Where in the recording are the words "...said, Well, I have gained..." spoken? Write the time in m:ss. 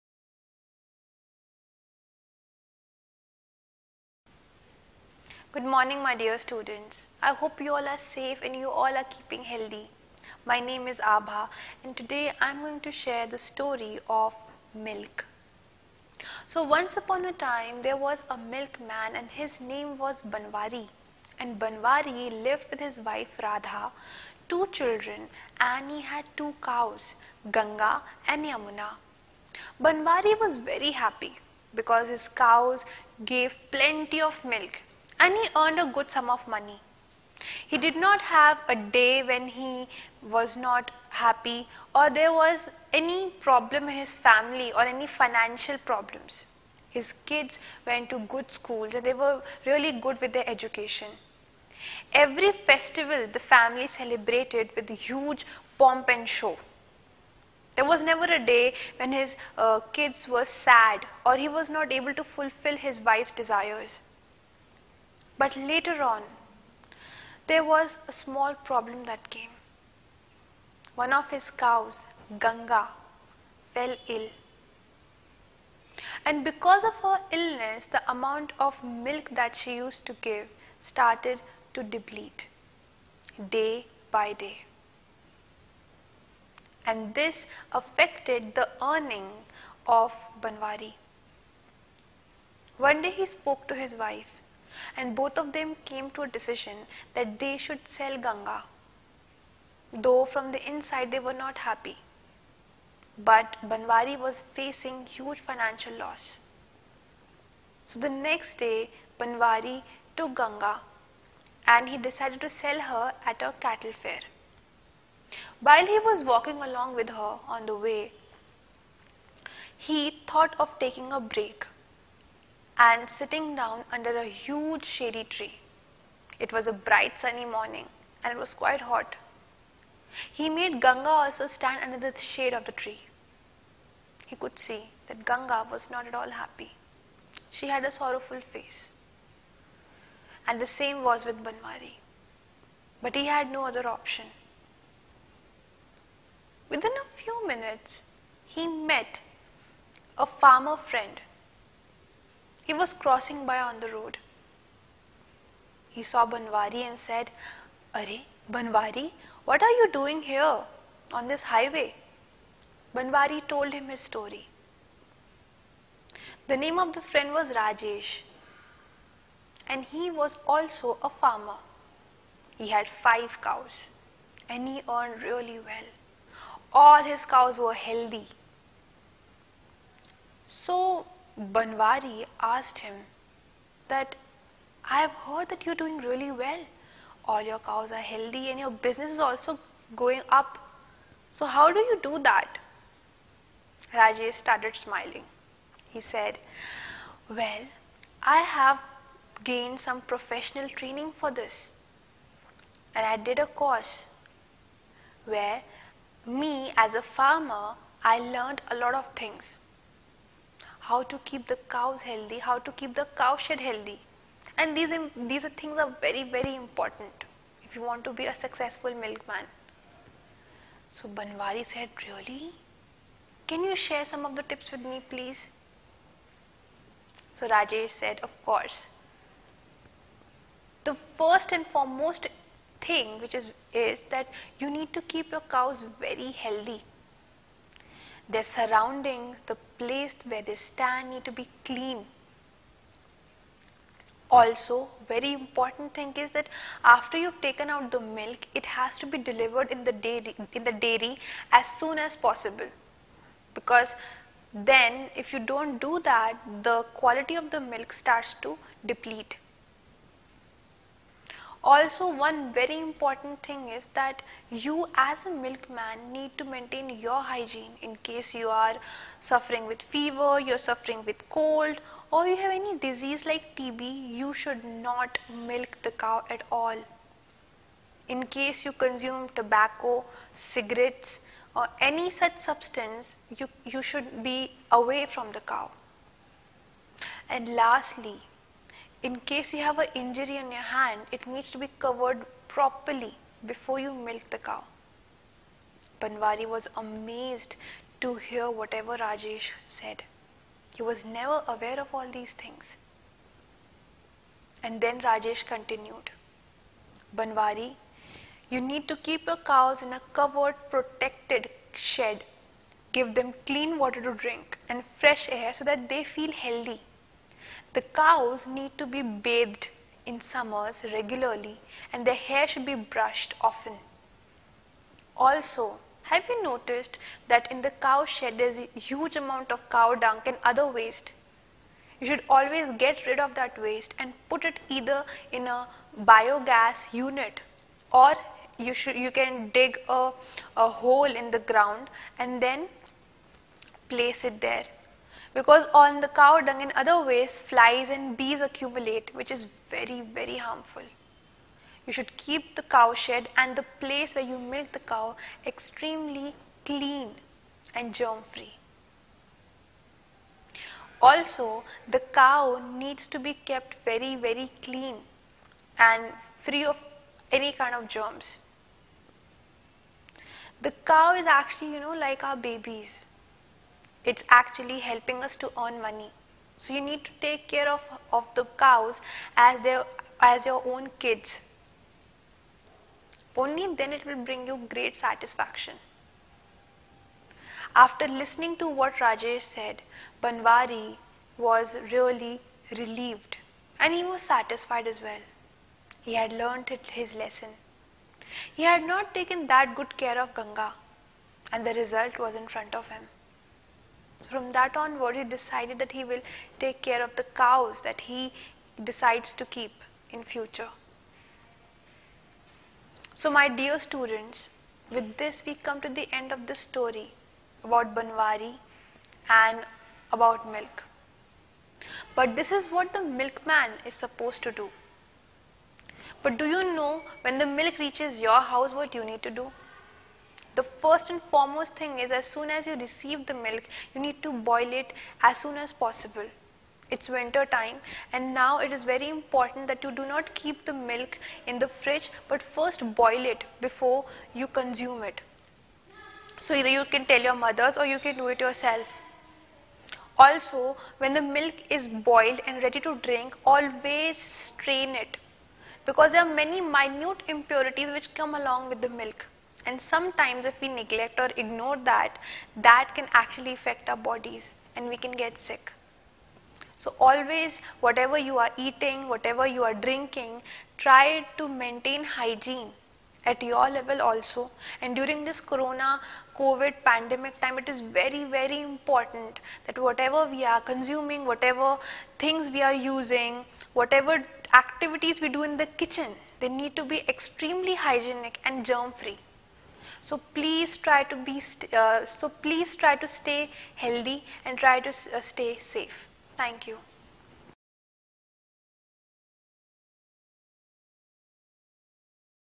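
3:16.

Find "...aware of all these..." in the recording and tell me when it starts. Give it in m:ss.
5:01.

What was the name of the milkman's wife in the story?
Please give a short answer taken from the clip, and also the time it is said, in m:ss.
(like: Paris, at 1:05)
Radha, at 0:23.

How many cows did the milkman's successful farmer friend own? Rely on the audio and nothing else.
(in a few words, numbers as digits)
5.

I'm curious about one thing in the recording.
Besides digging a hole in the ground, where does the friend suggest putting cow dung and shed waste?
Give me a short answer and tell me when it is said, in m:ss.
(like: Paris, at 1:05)
A biogas unit, at 5:36.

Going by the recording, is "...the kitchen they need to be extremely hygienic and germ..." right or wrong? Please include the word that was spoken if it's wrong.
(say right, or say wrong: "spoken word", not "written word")
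right.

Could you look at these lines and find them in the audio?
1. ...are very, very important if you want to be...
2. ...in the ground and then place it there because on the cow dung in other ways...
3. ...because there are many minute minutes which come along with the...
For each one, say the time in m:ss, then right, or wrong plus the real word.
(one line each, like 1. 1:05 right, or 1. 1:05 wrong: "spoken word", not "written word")
1. 3:35 right
2. 5:41 right
3. 7:35 wrong: "impurities", not "minutes".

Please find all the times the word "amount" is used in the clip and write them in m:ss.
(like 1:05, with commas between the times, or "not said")
1:18, 5:29.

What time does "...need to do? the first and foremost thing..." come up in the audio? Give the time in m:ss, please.
7:09.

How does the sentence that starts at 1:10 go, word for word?
One of his cows, Ganga, fell ill.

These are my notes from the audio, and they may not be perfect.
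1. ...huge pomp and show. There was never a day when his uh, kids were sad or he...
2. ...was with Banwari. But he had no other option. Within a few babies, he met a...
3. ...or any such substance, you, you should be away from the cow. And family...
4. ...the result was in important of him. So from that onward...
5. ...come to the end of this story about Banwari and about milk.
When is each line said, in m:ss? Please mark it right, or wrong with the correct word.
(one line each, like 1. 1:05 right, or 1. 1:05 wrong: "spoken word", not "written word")
1. 0:54 right
2. 2:21 wrong: "minutes", not "babies"
3. 4:41 wrong: "lastly", not "family"
4. 6:41 wrong: "front", not "important"
5. 6:55 right.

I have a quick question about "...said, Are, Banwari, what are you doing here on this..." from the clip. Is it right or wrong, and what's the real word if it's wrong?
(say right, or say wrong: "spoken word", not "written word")
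right.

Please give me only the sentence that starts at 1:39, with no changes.
Though from the inside they were not happy.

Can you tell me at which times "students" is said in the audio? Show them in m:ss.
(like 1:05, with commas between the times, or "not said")
0:06, 6:53.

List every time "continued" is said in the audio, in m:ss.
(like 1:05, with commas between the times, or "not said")
5:05.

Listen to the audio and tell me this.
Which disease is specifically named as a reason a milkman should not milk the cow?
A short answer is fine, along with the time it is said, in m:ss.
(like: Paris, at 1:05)
TB, at 4:33.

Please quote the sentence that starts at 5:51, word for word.
You should keep the cow shed and the place where you milk the cow extremely clean and germ free.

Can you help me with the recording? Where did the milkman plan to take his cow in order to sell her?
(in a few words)
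A cattle fair.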